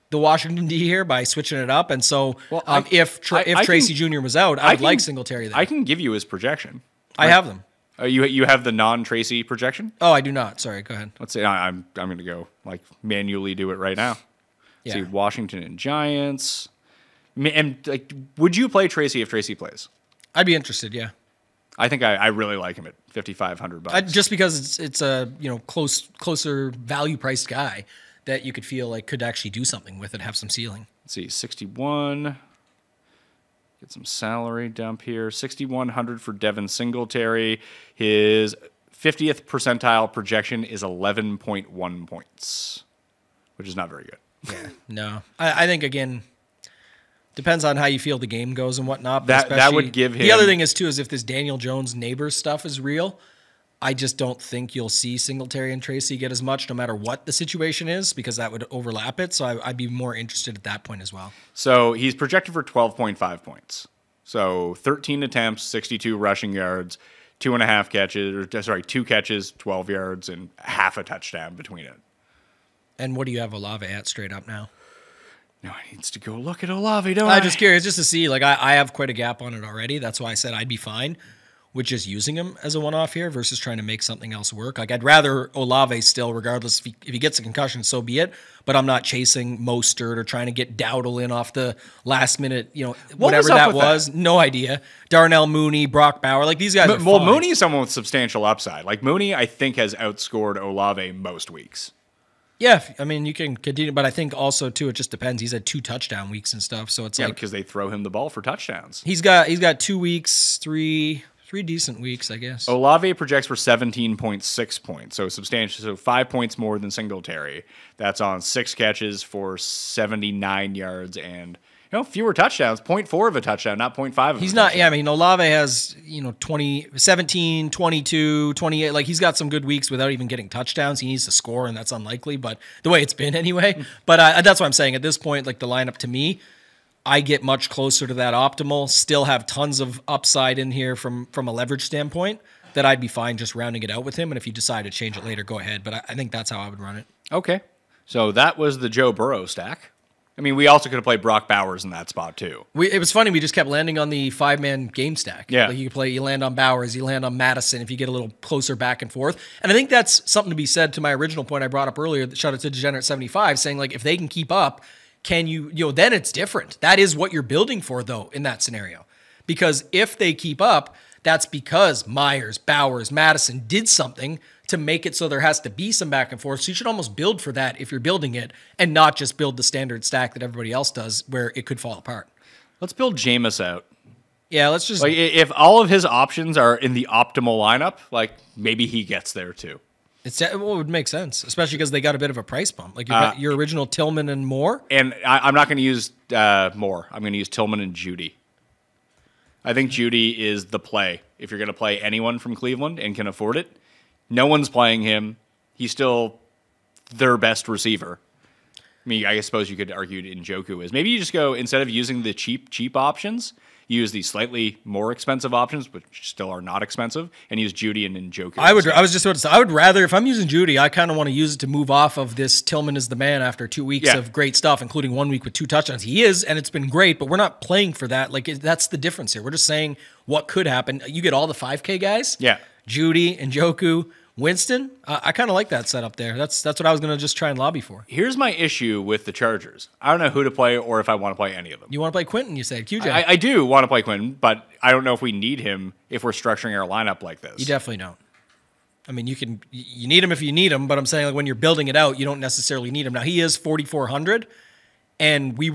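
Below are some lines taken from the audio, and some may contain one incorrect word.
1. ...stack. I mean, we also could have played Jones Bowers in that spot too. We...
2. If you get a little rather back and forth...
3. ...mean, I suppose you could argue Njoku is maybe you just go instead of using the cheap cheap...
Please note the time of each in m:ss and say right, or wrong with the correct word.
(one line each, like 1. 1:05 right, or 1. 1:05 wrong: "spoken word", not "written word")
1. 2:29 wrong: "Brock", not "Jones"
2. 2:37 wrong: "closer", not "rather"
3. 3:29 right.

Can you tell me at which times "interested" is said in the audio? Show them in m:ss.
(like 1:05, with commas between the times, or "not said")
0:20, 1:00.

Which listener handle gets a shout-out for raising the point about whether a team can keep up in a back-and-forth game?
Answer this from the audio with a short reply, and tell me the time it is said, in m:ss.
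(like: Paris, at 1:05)
Degenerate 75, at 2:42.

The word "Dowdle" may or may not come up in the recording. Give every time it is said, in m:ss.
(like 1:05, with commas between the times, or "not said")
1:30.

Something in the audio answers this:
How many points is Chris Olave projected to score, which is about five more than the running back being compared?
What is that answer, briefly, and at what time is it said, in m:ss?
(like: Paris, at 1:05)
17.6, at 1:53.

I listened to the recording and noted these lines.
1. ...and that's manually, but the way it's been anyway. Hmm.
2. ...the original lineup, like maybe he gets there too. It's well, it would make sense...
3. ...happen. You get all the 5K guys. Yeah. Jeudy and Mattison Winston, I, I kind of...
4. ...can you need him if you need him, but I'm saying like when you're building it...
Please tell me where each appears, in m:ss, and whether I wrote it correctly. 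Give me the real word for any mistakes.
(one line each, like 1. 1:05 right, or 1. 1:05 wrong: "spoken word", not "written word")
1. 2:11 wrong: "unlikely", not "manually"
2. 3:06 wrong: "optimal", not "original"
3. 3:50 wrong: "Njoku", not "Mattison"
4. 4:09 right.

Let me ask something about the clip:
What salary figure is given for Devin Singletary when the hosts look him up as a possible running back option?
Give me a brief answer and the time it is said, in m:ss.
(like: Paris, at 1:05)
6,100, at 0:35.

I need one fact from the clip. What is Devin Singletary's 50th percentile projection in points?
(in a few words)
11.1.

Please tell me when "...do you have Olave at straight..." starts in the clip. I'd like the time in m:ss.
1:13.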